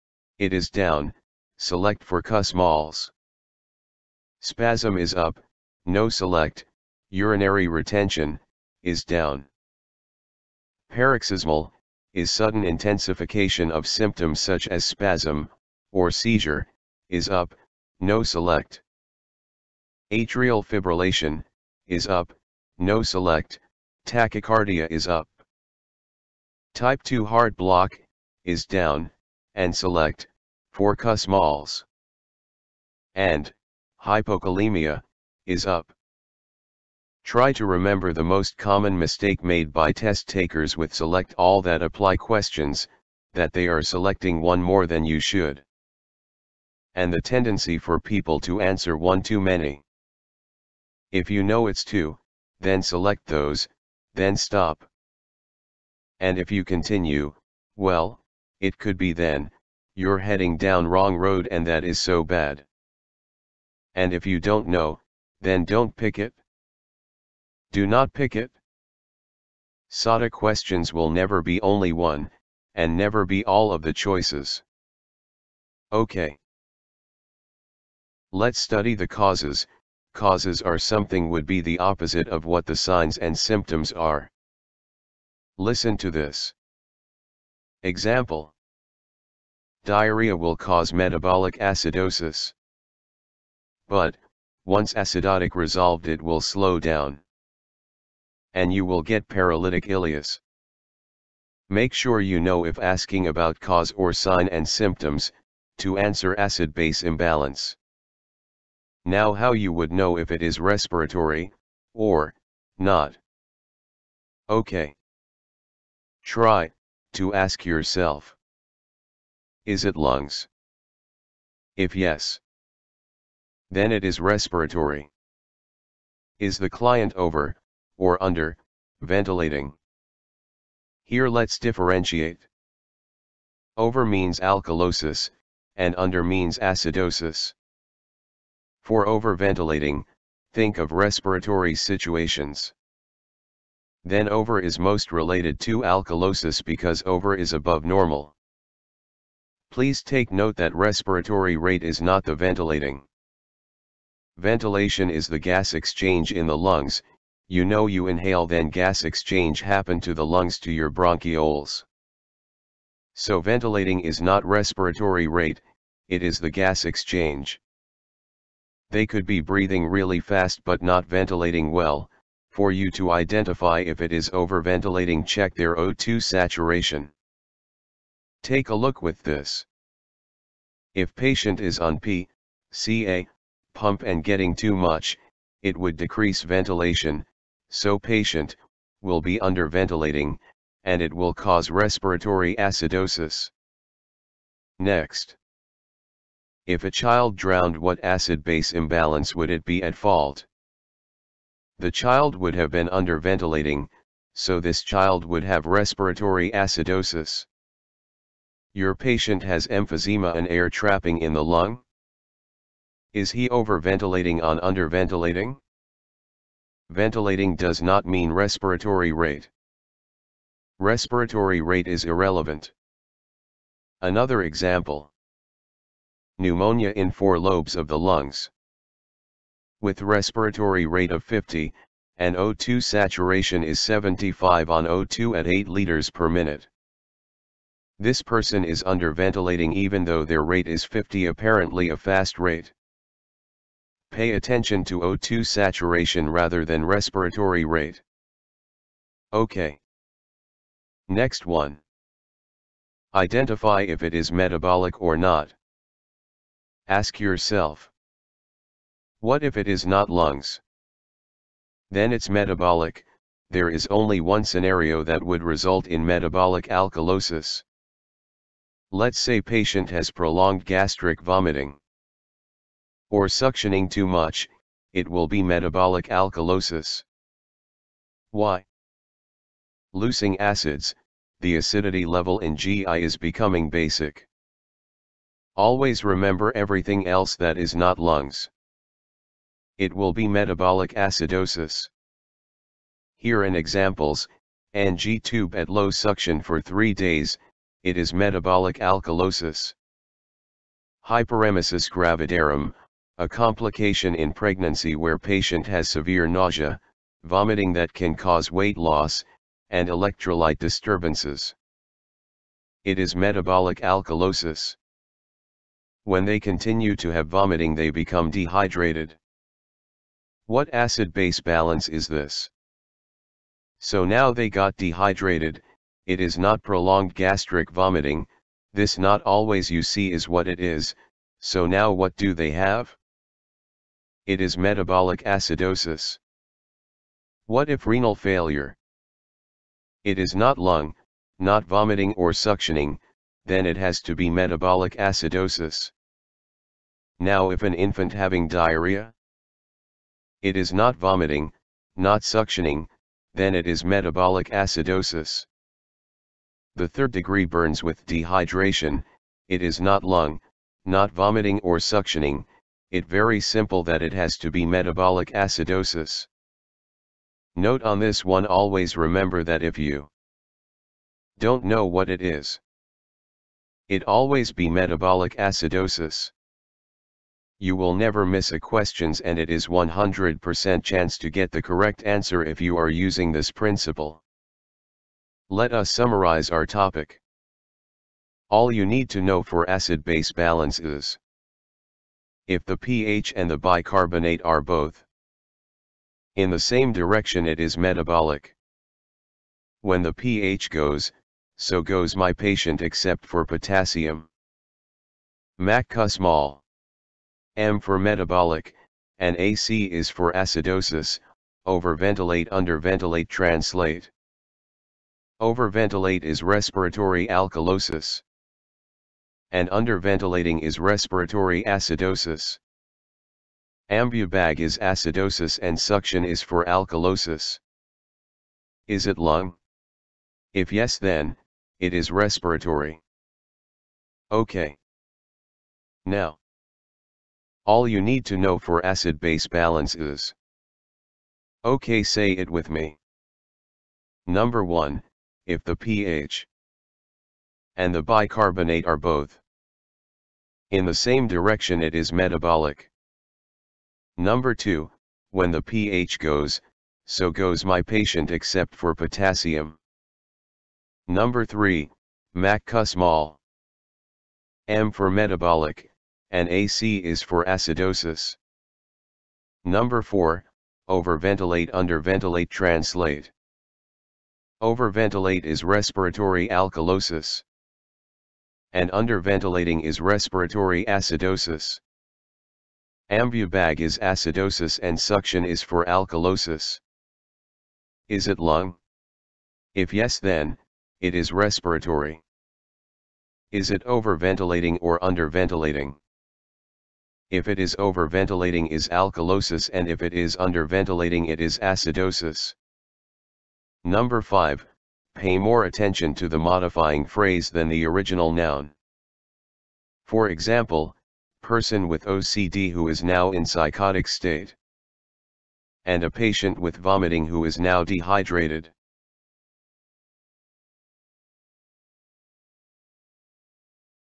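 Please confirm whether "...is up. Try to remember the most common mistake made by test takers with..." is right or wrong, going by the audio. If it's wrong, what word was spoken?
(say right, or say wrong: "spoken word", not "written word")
right.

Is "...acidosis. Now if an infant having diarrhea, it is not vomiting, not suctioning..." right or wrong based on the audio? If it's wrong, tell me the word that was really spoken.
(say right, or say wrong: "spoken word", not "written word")
right.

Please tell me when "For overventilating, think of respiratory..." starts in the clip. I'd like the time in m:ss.
2:18.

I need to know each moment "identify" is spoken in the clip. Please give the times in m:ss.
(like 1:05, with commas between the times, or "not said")
2:53, 4:13.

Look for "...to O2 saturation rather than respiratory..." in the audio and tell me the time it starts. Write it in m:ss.
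4:04.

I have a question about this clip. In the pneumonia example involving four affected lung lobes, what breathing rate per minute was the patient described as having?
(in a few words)
50.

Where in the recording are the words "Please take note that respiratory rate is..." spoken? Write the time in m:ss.
2:29.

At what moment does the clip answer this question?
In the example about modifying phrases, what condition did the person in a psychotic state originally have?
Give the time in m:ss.
8:32.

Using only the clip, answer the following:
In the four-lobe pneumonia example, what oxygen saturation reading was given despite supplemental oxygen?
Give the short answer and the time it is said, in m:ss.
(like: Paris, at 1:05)
75, at 3:52.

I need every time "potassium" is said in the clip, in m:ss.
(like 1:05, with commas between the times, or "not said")
6:43, 7:38.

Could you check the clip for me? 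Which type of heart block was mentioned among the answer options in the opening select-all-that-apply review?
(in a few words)
Type 2.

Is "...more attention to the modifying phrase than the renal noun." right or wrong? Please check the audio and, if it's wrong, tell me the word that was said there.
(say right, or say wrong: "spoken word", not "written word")
wrong: "original", not "renal".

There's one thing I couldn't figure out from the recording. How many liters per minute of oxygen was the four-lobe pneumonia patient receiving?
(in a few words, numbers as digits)
8.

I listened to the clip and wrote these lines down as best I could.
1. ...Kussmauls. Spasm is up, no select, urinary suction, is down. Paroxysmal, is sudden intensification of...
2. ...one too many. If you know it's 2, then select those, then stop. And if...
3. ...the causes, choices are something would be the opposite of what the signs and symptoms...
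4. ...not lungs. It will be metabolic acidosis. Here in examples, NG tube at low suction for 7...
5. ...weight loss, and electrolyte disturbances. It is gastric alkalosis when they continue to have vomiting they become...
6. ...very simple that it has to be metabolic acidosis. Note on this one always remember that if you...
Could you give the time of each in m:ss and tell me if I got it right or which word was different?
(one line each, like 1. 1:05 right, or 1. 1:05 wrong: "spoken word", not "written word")
1. 0:02 wrong: "retention", not "suction"
2. 0:48 right
3. 1:18 wrong: "causes", not "choices"
4. 4:47 wrong: "3", not "7"
5. 5:08 wrong: "metabolic", not "gastric"
6. 6:03 right.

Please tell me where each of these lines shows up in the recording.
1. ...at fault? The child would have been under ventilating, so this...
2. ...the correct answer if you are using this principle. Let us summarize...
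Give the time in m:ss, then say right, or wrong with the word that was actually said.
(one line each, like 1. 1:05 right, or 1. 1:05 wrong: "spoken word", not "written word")
1. 3:19 right
2. 6:21 right.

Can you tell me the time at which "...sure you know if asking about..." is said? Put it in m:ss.
1:41.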